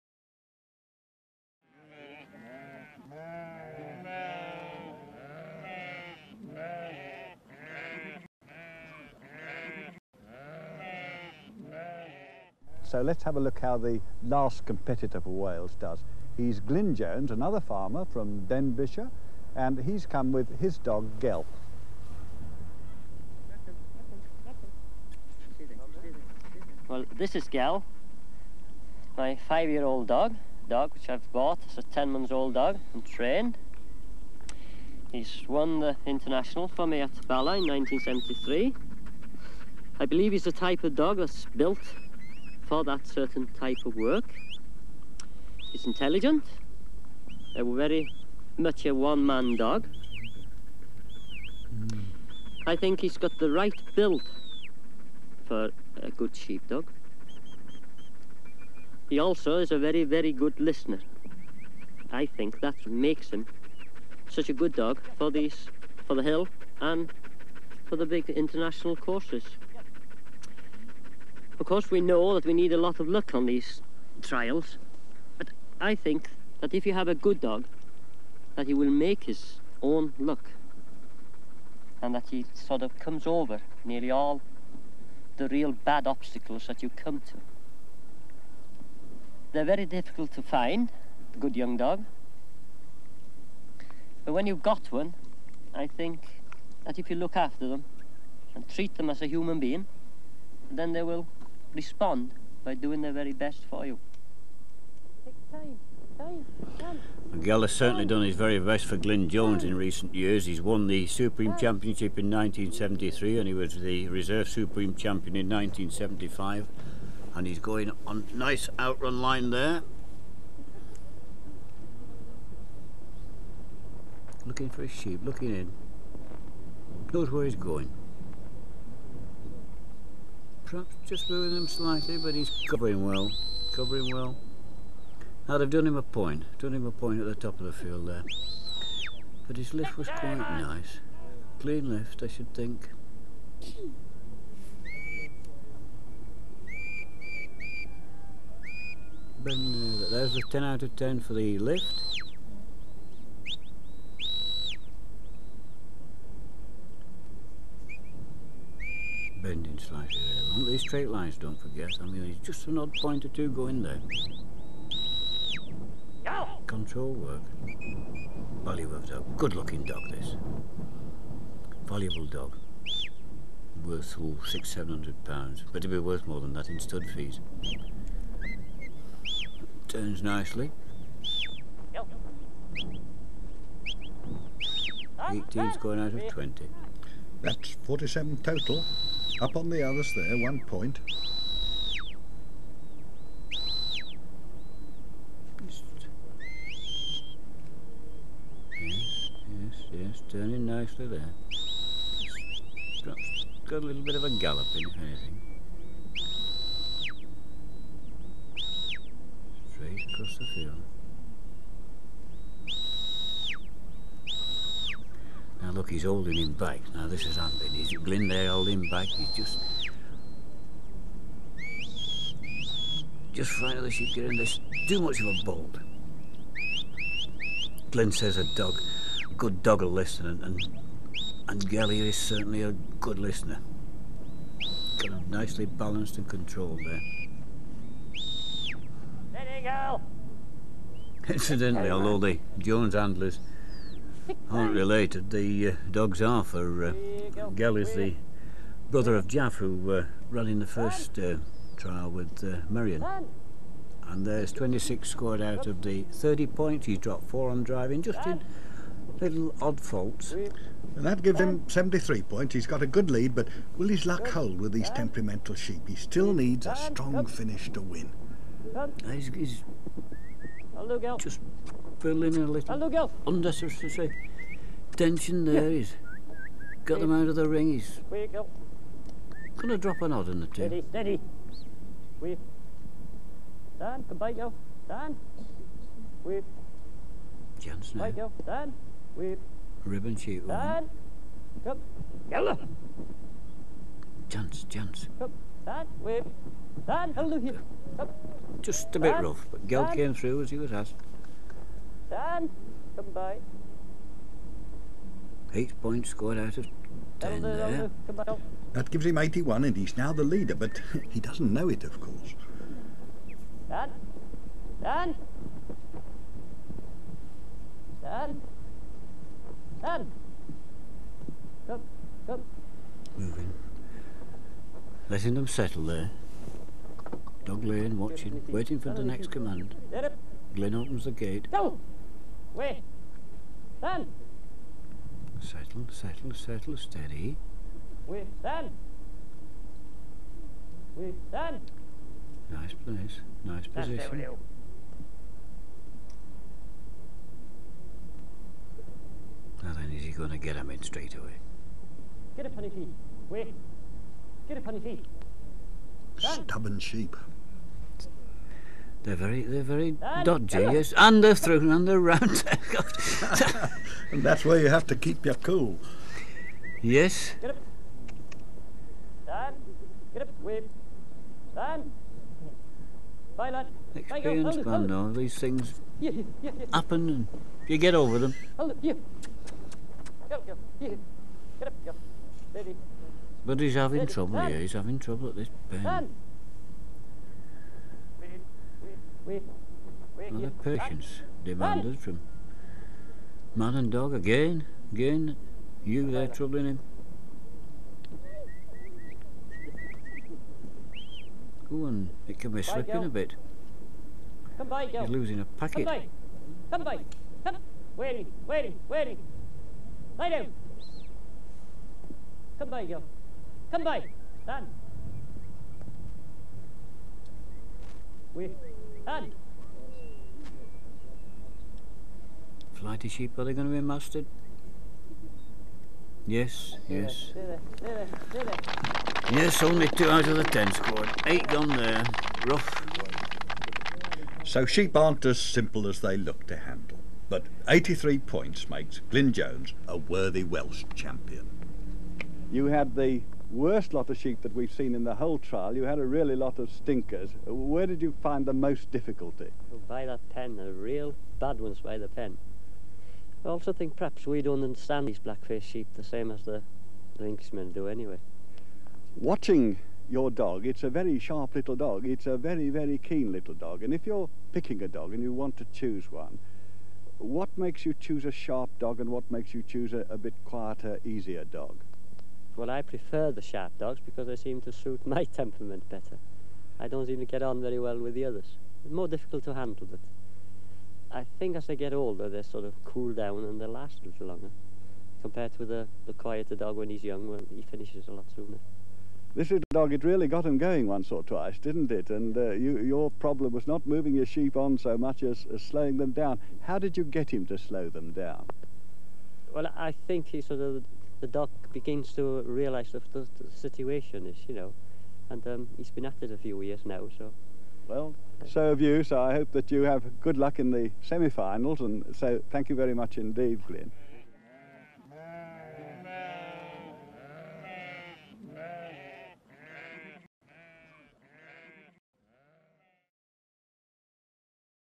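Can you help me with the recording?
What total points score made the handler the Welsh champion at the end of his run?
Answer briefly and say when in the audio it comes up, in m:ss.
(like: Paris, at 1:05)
83, at 7:17.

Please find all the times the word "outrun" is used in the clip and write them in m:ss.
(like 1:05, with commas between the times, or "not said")
1:58.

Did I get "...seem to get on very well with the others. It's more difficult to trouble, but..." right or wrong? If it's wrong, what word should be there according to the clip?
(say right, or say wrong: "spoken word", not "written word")
wrong: "handle", not "trouble".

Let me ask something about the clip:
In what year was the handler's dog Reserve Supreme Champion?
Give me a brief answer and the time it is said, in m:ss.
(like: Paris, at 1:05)
1975, at 1:55.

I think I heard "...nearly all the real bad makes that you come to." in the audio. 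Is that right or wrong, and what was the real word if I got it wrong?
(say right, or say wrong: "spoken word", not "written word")
wrong: "obstacles", not "makes".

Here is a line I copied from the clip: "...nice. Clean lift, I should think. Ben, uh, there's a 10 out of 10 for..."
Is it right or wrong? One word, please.
right.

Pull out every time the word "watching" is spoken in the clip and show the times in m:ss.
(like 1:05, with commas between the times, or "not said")
5:27, 7:39.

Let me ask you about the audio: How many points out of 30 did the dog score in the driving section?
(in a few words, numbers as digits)
26.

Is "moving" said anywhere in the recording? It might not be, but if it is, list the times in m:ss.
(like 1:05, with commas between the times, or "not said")
2:11, 5:23, 8:13.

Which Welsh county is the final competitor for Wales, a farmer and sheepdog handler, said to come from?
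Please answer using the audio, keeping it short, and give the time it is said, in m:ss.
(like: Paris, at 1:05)
Denbighshire, at 0:18.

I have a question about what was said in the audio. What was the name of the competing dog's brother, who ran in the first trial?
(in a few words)
Jaff.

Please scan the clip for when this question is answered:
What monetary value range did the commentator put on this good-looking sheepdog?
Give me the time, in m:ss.
2:54.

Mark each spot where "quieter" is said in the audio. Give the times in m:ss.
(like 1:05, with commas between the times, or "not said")
7:50, 8:06.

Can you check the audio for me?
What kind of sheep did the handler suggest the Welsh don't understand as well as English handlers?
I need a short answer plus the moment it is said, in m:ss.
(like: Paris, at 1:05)
black-faced sheep, at 7:35.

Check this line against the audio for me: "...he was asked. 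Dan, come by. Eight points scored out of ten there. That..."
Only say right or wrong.
right.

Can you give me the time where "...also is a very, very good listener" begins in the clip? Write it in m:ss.
0:59.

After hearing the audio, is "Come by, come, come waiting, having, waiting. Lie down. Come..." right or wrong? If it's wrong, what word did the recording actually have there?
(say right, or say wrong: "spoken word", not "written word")
wrong: "waiting", not "having".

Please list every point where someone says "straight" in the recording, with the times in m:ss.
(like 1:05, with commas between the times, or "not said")
2:40, 3:29, 5:50.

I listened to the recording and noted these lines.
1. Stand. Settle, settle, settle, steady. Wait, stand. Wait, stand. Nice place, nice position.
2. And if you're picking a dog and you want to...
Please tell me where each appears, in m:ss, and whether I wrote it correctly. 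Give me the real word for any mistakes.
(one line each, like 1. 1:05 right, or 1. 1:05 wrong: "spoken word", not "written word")
1. 5:33 right
2. 7:43 right.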